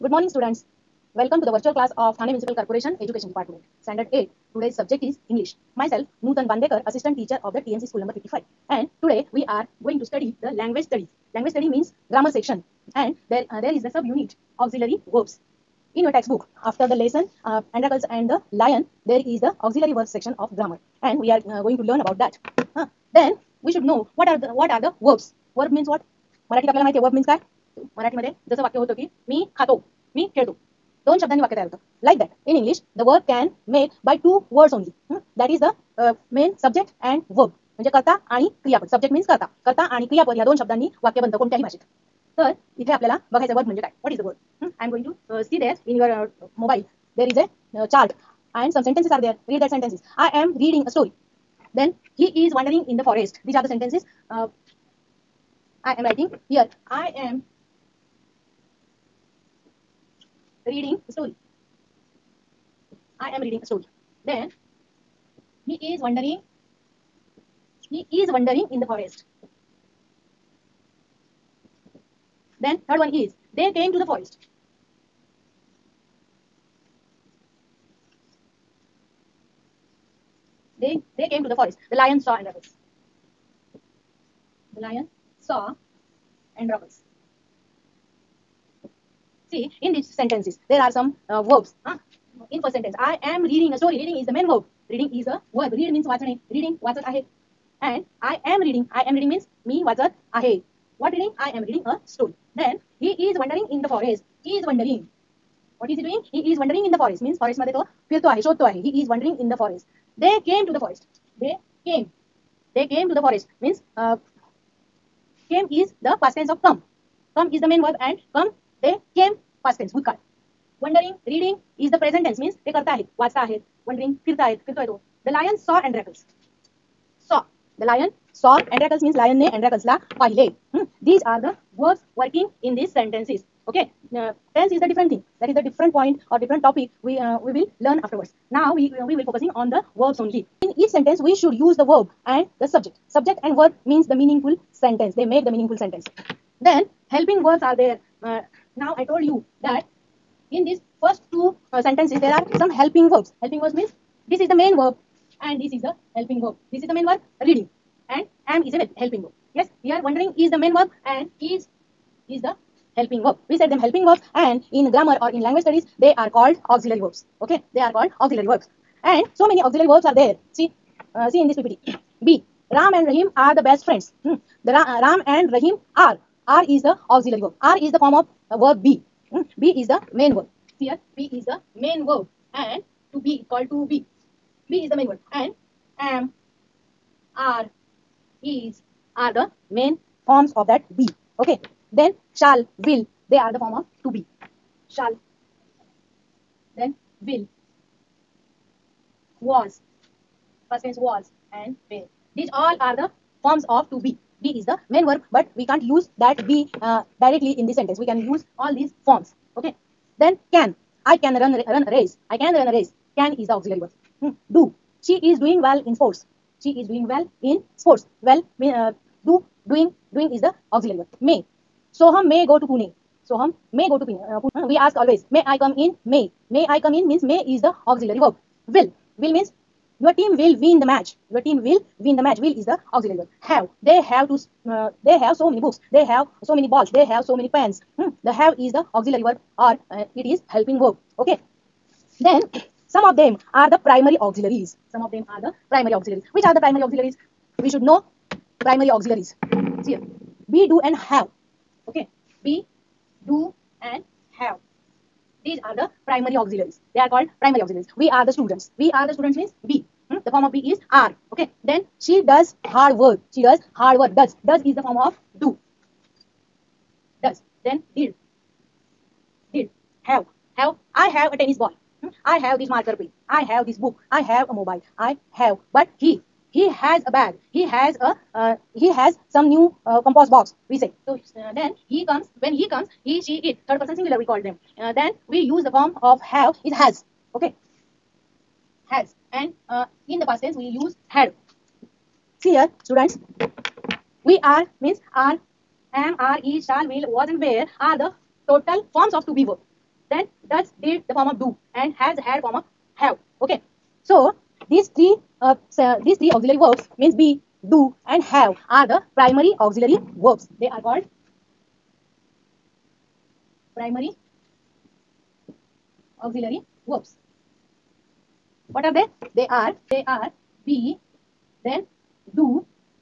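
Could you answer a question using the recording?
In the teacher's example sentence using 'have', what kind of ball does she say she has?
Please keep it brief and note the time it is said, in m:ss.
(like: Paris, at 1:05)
tennis ball, at 4:31.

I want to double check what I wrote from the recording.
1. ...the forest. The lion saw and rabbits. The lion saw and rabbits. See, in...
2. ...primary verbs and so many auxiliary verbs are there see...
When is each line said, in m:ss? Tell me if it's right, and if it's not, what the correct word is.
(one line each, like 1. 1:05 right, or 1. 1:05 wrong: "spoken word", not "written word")
1. 1:21 right
2. 2:48 wrong: "auxiliary", not "primary".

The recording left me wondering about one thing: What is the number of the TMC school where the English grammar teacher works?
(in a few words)
55.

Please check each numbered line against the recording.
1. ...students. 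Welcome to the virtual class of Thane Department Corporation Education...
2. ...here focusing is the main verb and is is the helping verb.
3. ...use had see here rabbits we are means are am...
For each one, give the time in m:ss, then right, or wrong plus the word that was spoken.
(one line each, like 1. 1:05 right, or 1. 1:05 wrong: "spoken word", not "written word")
1. 0:00 wrong: "Municipal", not "Department"
2. 2:39 wrong: "wondering", not "focusing"
3. 4:50 wrong: "students", not "rabbits".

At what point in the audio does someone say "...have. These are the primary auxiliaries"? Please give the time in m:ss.
4:14.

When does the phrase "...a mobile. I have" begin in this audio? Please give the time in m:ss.
4:34.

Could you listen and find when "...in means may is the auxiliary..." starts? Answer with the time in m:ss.
3:46.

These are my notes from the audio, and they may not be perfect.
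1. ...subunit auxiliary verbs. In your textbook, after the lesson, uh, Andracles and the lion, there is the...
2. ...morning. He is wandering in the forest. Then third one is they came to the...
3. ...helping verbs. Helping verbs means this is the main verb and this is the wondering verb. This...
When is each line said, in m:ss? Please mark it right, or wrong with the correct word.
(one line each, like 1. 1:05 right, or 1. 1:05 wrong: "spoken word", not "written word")
1. 0:13 right
2. 1:06 wrong: "wondering", not "morning"
3. 2:32 wrong: "helping", not "wondering".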